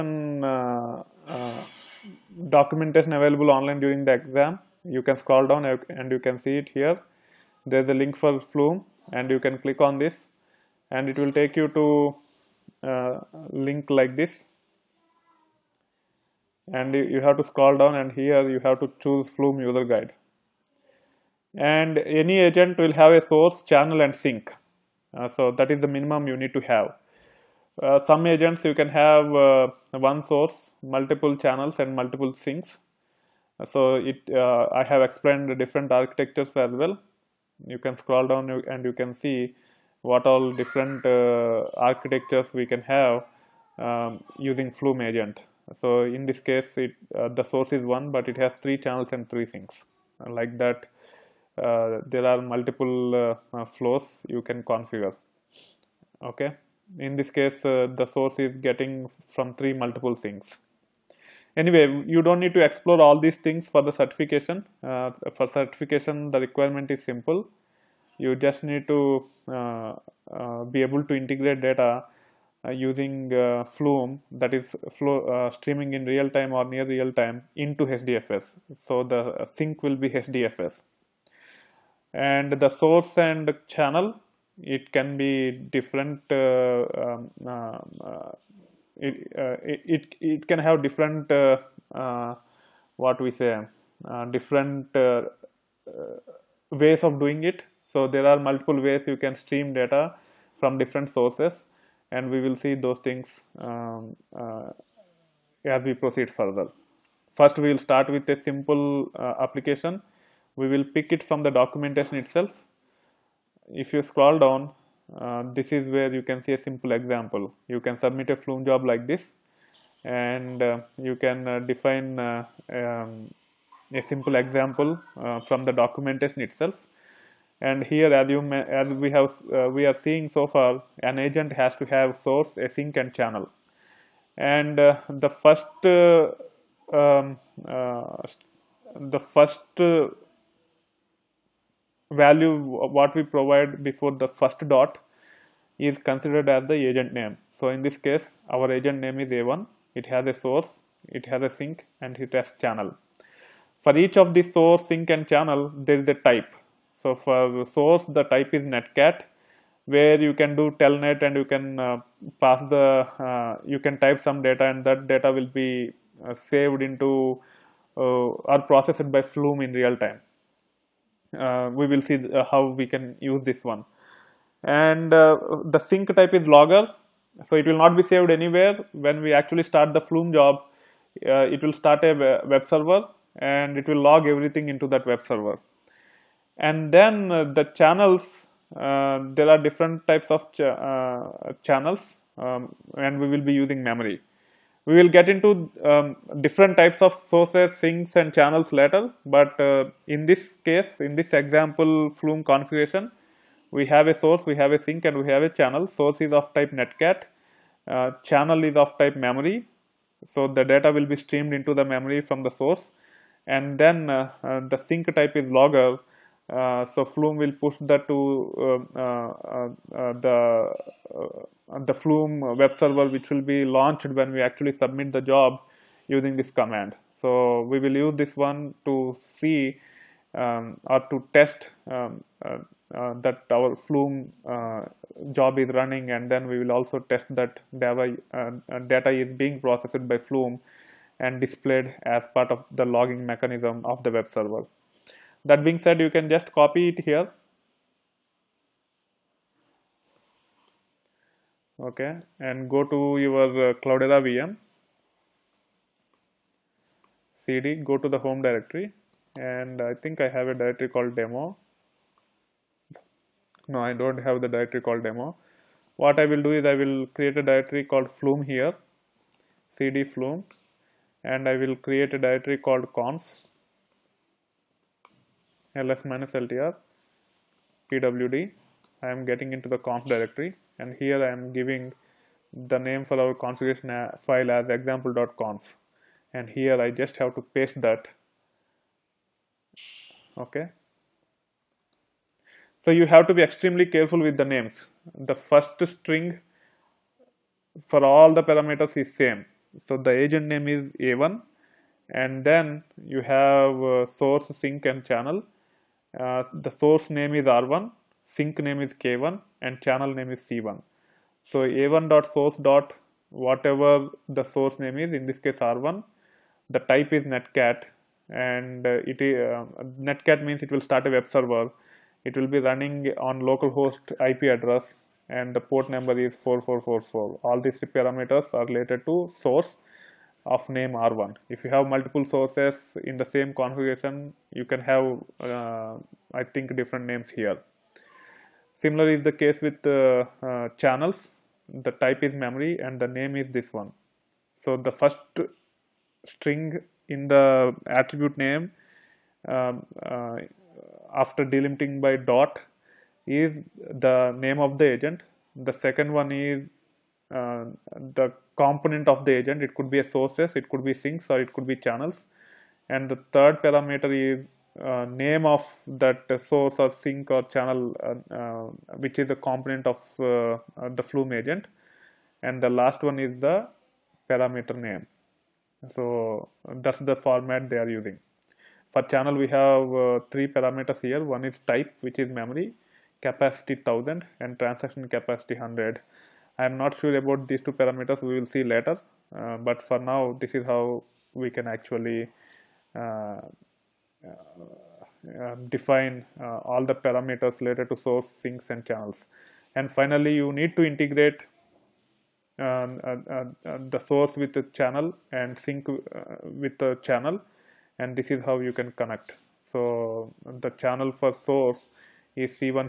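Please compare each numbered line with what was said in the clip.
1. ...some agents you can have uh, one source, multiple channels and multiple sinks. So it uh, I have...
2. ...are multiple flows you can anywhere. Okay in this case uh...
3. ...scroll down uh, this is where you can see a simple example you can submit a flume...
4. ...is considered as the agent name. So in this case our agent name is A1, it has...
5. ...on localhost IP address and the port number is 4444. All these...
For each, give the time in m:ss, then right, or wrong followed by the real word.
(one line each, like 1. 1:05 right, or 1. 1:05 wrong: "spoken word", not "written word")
1. 0:28 right
2. 0:52 wrong: "configure", not "anywhere"
3. 1:54 right
4. 2:25 right
5. 5:23 right.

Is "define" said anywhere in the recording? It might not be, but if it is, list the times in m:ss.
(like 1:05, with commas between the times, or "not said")
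2:01, 6:35.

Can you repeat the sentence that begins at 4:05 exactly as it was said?
That being said, you can just copy it here.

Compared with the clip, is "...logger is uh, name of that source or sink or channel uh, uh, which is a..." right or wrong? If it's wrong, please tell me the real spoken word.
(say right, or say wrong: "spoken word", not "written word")
wrong: "parameter", not "logger".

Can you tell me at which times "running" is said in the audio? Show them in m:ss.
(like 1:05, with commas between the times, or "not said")
3:55, 5:22.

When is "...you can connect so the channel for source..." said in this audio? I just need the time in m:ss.
6:48.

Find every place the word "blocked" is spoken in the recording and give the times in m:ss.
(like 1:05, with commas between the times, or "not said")
not said.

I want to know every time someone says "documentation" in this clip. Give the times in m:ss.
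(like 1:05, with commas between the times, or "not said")
0:02, 1:51, 2:05.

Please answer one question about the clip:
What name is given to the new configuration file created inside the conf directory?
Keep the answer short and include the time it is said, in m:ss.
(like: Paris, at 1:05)
example.conf, at 4:44.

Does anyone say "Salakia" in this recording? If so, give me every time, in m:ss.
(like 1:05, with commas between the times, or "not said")
not said.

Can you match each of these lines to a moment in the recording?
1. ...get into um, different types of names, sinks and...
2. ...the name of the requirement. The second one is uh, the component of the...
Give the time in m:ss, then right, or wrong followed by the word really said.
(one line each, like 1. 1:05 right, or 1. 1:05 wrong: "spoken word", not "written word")
1. 3:15 wrong: "sources", not "names"
2. 5:53 wrong: "agent", not "requirement".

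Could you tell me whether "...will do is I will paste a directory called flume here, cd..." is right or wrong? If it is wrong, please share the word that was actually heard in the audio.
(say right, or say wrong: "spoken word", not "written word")
wrong: "create", not "paste".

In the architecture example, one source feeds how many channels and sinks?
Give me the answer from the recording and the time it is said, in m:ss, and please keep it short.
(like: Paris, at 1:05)
3, at 0:48.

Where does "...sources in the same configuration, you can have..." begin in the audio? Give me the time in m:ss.
5:32.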